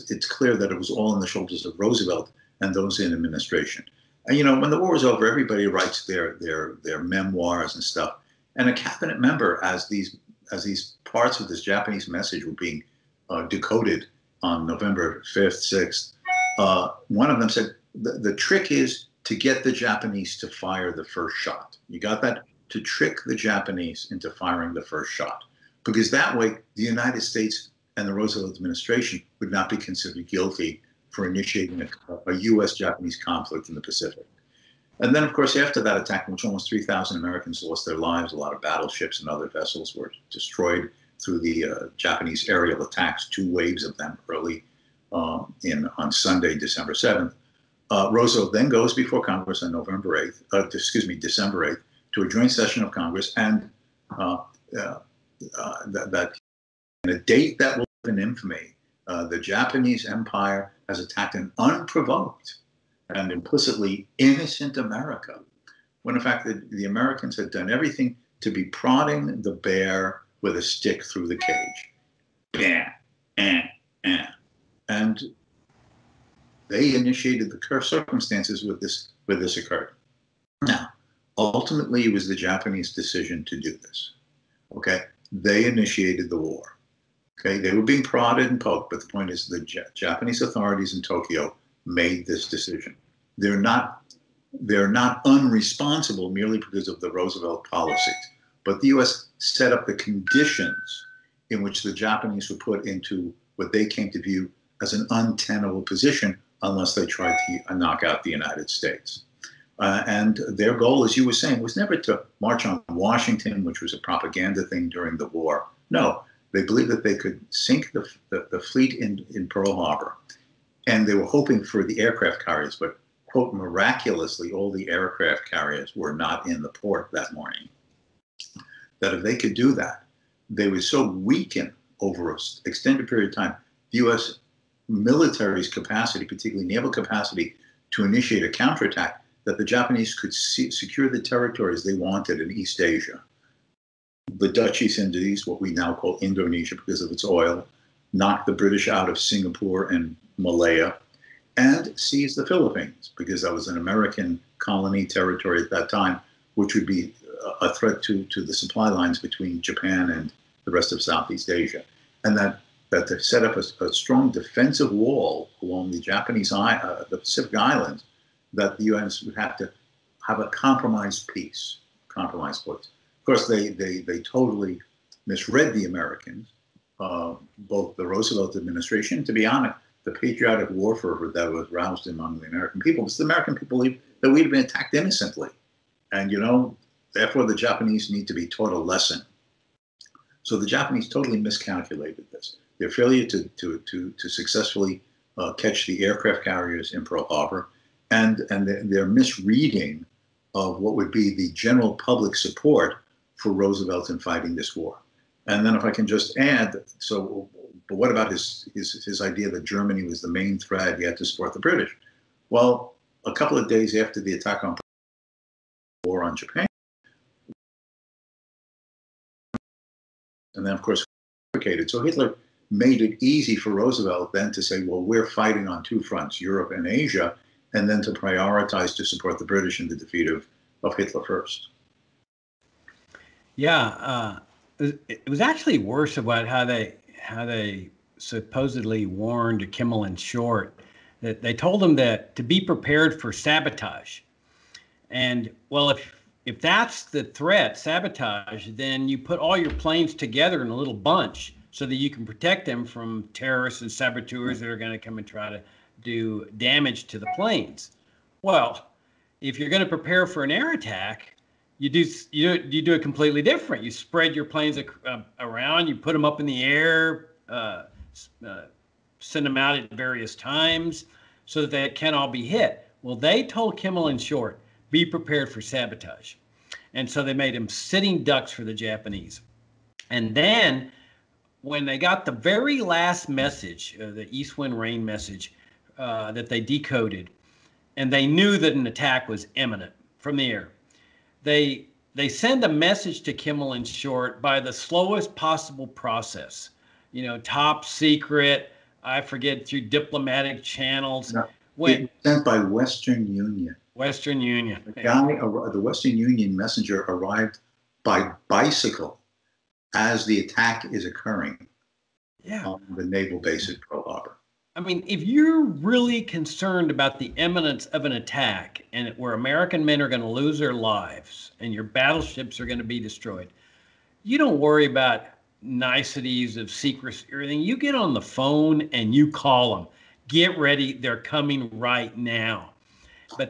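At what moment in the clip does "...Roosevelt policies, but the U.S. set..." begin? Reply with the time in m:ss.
1:37.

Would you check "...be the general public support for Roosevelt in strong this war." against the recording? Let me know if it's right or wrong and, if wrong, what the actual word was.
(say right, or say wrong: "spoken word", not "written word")
wrong: "fighting", not "strong".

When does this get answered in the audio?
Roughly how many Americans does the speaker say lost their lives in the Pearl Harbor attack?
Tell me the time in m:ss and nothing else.
0:36.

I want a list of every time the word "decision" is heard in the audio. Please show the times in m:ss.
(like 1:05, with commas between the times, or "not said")
1:22, 1:32.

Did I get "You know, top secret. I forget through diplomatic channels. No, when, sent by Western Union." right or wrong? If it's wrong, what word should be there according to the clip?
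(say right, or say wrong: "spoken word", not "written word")
right.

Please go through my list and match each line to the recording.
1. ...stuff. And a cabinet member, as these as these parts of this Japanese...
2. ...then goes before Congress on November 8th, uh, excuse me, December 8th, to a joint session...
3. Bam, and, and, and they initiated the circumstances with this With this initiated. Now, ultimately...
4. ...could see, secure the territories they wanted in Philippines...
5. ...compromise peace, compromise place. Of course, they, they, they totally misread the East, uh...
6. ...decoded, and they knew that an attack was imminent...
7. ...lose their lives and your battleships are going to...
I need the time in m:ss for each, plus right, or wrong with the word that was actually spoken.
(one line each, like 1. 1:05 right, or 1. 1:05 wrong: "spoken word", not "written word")
1. 0:07 right
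2. 0:48 right
3. 1:12 wrong: "occurred", not "initiated"
4. 2:20 wrong: "East", not "Philippines"
5. 2:50 wrong: "Americans", not "East"
6. 4:46 right
7. 5:20 right.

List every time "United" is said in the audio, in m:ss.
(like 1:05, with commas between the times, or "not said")
0:26, 1:48.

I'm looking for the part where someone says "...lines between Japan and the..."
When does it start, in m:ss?
2:38.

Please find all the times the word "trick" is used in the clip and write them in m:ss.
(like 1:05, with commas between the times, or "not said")
0:18, 0:22.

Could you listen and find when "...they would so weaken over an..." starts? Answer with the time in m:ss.
2:10.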